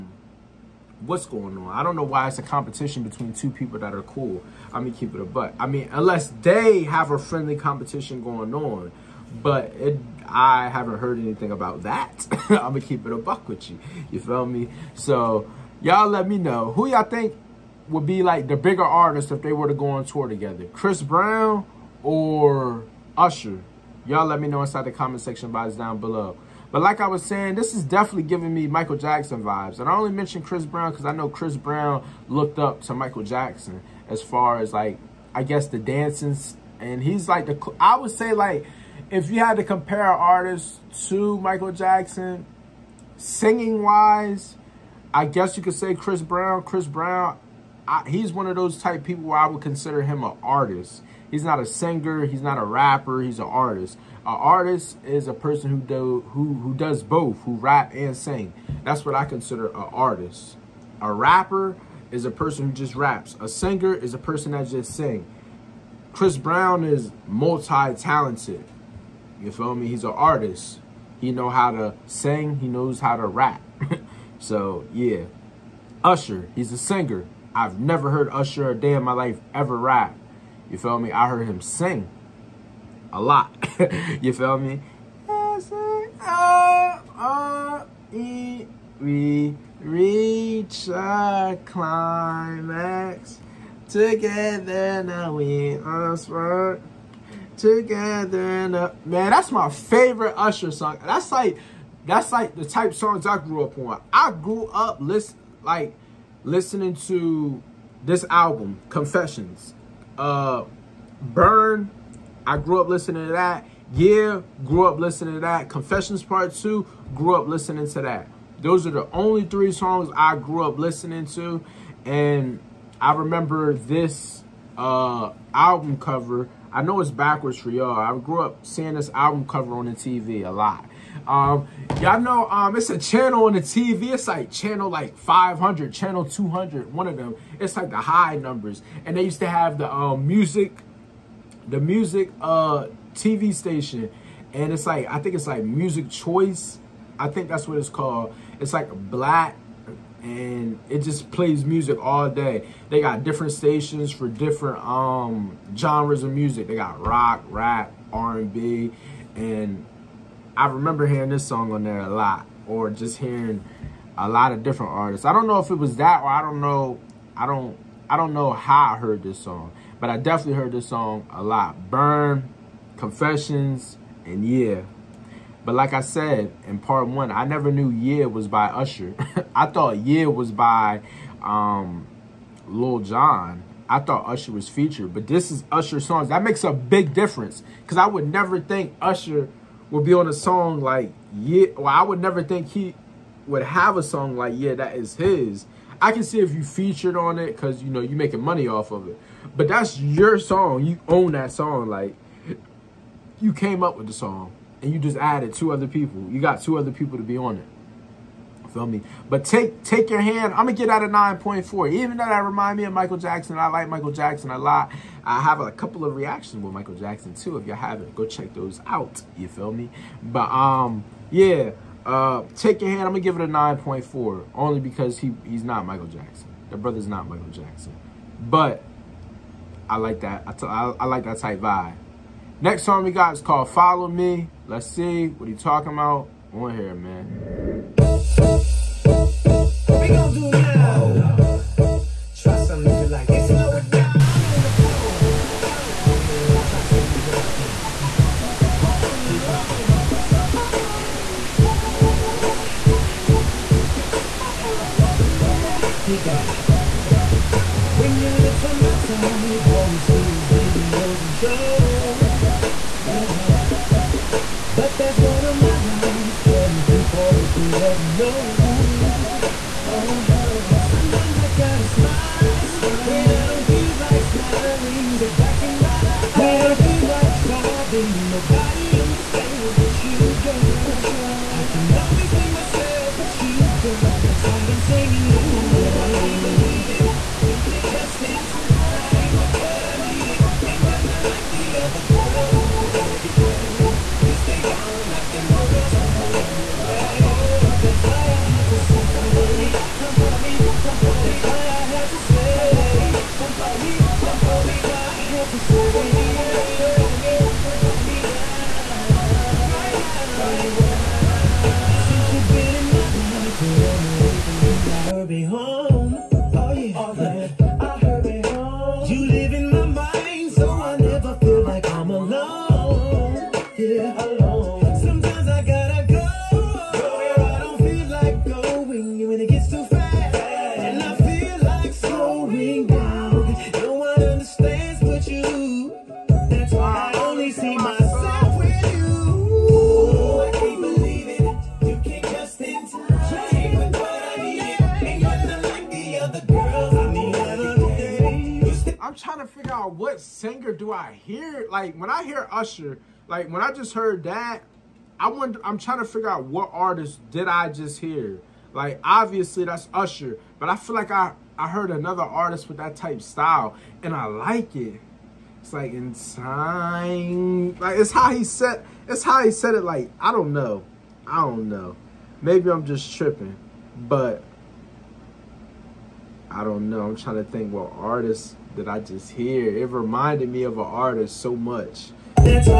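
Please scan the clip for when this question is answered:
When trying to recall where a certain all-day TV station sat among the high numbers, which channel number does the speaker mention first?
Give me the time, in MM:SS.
02:14.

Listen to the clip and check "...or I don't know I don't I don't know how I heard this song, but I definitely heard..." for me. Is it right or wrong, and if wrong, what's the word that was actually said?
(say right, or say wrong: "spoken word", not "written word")
right.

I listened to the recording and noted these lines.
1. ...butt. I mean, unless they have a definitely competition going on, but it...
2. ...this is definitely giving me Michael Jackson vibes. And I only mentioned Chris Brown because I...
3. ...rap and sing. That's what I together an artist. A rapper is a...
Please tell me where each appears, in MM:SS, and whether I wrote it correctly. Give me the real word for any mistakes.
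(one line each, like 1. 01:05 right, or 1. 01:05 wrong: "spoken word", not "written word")
1. 00:05 wrong: "friendly", not "definitely"
2. 00:27 right
3. 00:57 wrong: "consider", not "together".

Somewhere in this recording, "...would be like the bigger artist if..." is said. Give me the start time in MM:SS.
00:17.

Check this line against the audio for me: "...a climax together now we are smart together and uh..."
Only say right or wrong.
right.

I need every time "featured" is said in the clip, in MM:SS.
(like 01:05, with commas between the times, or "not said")
03:04, 03:16.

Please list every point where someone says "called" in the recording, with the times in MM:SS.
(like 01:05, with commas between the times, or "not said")
02:27, 03:53.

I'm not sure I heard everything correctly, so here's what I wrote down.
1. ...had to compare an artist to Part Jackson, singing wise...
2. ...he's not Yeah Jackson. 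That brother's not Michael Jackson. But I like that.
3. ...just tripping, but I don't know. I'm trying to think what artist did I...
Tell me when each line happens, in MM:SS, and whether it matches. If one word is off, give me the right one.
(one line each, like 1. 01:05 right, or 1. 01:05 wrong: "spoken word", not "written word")
1. 00:39 wrong: "Michael", not "Part"
2. 03:45 wrong: "Michael", not "Yeah"
3. 06:12 right.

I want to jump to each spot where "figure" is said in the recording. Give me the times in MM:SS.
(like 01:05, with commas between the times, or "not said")
05:56.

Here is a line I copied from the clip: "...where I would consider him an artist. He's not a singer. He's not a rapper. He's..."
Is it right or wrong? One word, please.
right.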